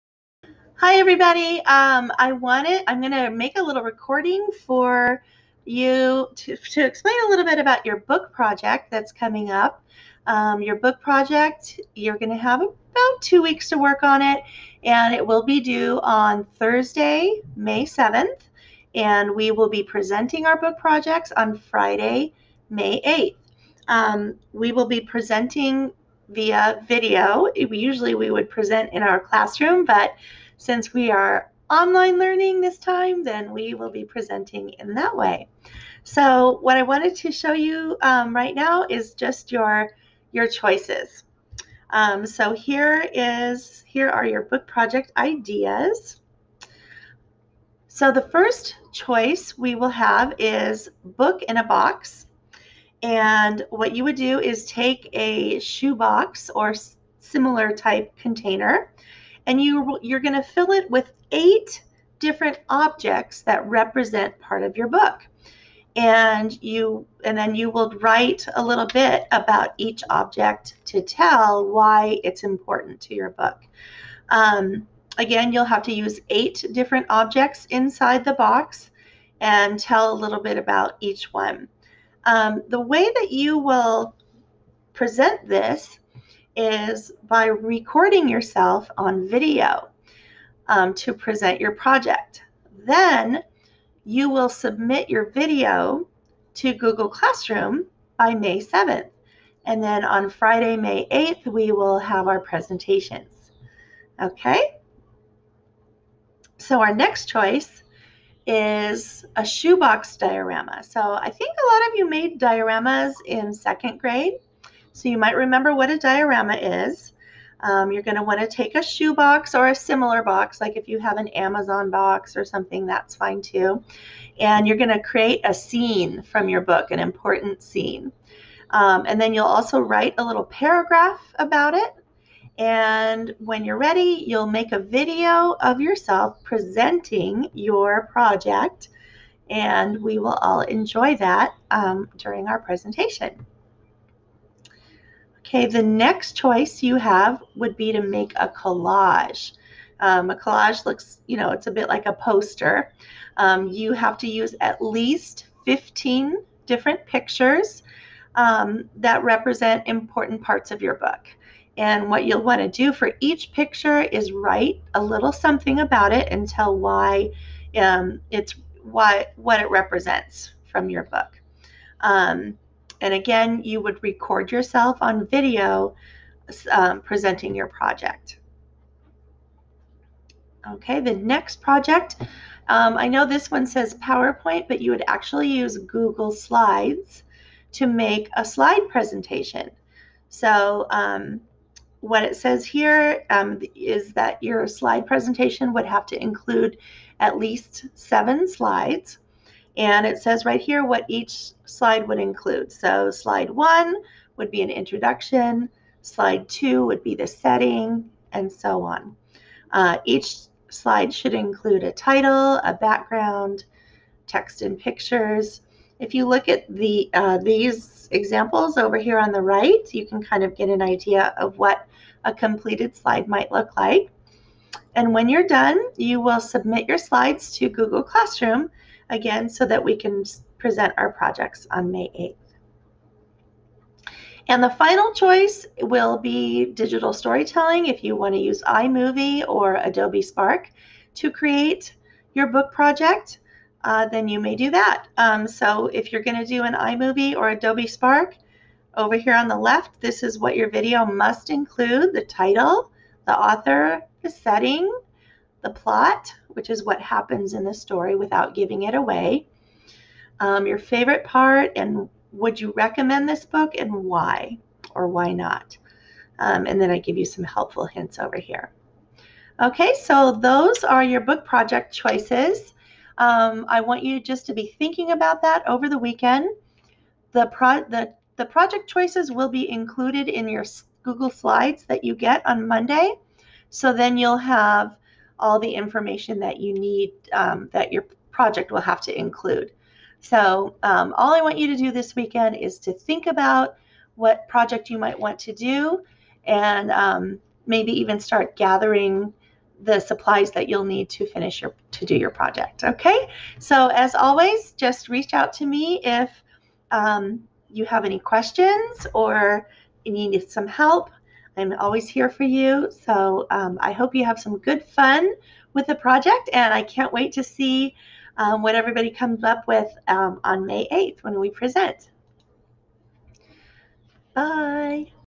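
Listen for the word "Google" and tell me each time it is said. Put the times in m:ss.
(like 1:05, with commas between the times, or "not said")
1:36, 3:05, 3:47, 4:41.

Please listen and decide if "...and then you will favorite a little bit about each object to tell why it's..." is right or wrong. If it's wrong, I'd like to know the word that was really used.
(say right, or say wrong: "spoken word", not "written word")
wrong: "write", not "favorite".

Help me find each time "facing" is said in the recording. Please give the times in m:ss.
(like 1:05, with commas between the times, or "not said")
not said.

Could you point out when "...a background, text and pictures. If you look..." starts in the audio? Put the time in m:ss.
3:32.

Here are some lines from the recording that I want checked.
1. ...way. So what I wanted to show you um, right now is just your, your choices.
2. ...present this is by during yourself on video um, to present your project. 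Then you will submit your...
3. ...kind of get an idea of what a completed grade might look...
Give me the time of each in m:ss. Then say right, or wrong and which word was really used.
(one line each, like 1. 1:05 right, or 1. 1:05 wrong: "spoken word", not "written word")
1. 0:35 right
2. 1:24 wrong: "recording", not "during"
3. 3:40 wrong: "slide", not "grade".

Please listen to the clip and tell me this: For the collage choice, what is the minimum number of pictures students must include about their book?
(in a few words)
15.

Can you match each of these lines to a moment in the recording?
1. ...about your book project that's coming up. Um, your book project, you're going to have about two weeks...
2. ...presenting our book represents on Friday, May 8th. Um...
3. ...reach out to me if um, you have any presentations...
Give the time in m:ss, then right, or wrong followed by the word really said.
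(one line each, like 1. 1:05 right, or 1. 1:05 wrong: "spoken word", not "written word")
1. 0:07 right
2. 0:19 wrong: "projects", not "represents"
3. 5:05 wrong: "questions", not "presentations".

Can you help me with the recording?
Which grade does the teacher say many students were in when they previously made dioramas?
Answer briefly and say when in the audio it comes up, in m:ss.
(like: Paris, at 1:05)
second grade, at 1:53.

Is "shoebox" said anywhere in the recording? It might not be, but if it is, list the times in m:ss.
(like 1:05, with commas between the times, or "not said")
0:55, 1:49, 1:58.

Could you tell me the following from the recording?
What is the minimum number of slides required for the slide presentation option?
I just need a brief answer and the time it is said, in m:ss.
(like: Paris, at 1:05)
7, at 3:17.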